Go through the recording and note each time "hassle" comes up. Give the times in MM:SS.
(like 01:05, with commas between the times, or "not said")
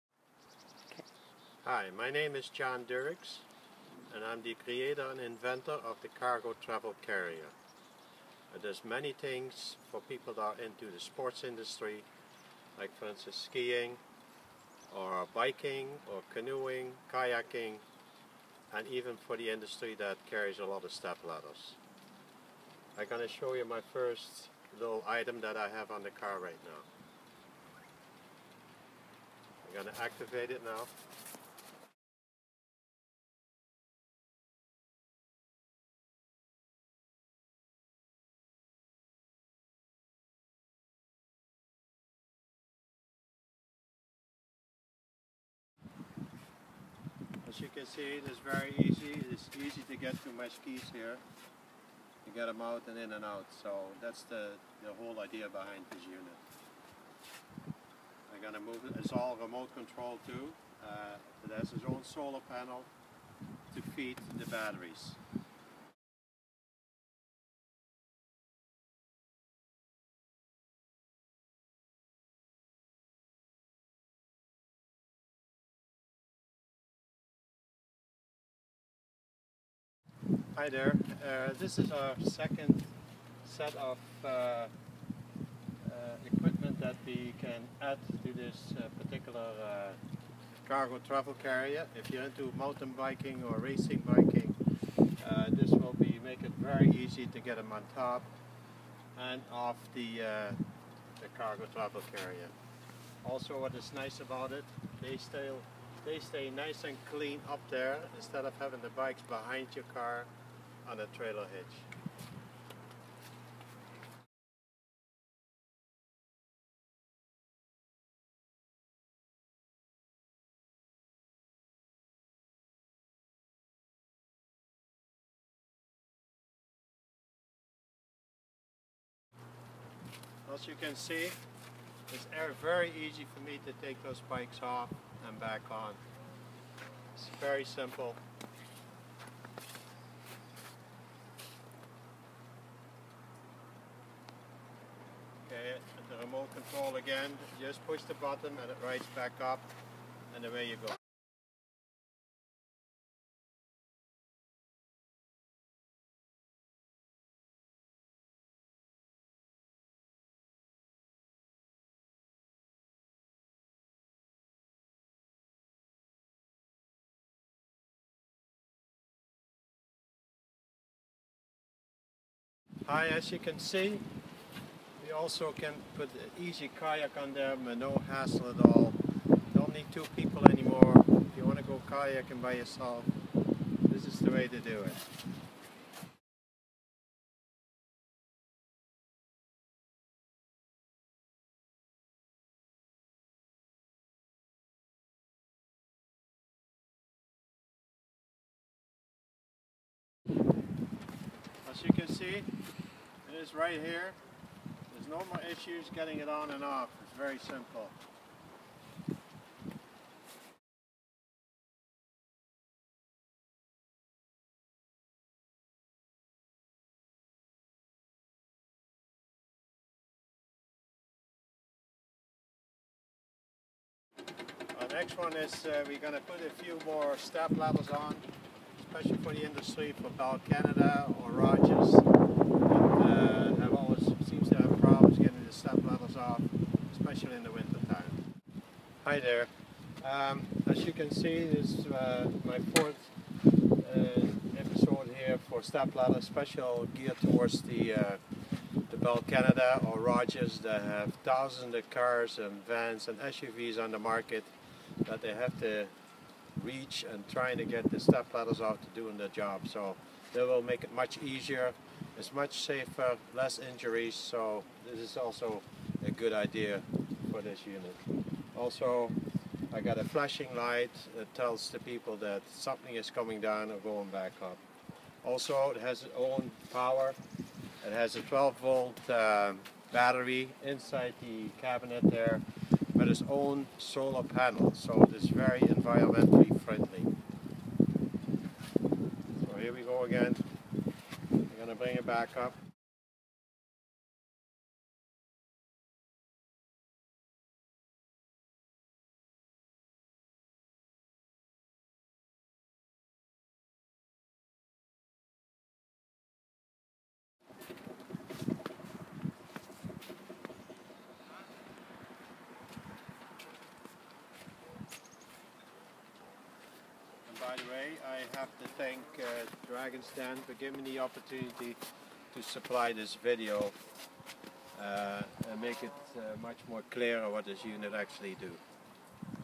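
02:58.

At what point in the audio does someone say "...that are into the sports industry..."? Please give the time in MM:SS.
00:10.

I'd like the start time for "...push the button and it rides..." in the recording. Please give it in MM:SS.
02:27.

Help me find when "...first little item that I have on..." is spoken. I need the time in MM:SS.
00:23.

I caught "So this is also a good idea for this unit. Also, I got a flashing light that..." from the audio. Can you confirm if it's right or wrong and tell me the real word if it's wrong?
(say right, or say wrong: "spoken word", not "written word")
right.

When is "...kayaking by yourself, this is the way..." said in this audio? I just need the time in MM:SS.
03:01.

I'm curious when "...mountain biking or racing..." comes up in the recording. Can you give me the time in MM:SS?
01:32.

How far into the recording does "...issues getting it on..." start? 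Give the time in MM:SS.
03:25.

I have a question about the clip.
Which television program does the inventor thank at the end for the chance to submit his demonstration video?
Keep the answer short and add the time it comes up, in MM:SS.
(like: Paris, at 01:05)
Dragon's Den, at 05:19.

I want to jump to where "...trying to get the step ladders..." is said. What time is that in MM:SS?
04:17.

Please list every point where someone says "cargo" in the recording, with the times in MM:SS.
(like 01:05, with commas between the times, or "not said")
00:06, 01:30, 01:41.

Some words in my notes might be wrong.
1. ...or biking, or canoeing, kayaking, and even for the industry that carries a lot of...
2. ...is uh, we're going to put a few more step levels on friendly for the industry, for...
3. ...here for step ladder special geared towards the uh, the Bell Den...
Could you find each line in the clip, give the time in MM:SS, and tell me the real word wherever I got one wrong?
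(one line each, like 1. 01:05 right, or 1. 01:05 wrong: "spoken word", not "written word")
1. 00:14 right
2. 03:45 wrong: "especially", not "friendly"
3. 04:05 wrong: "Canada", not "Den".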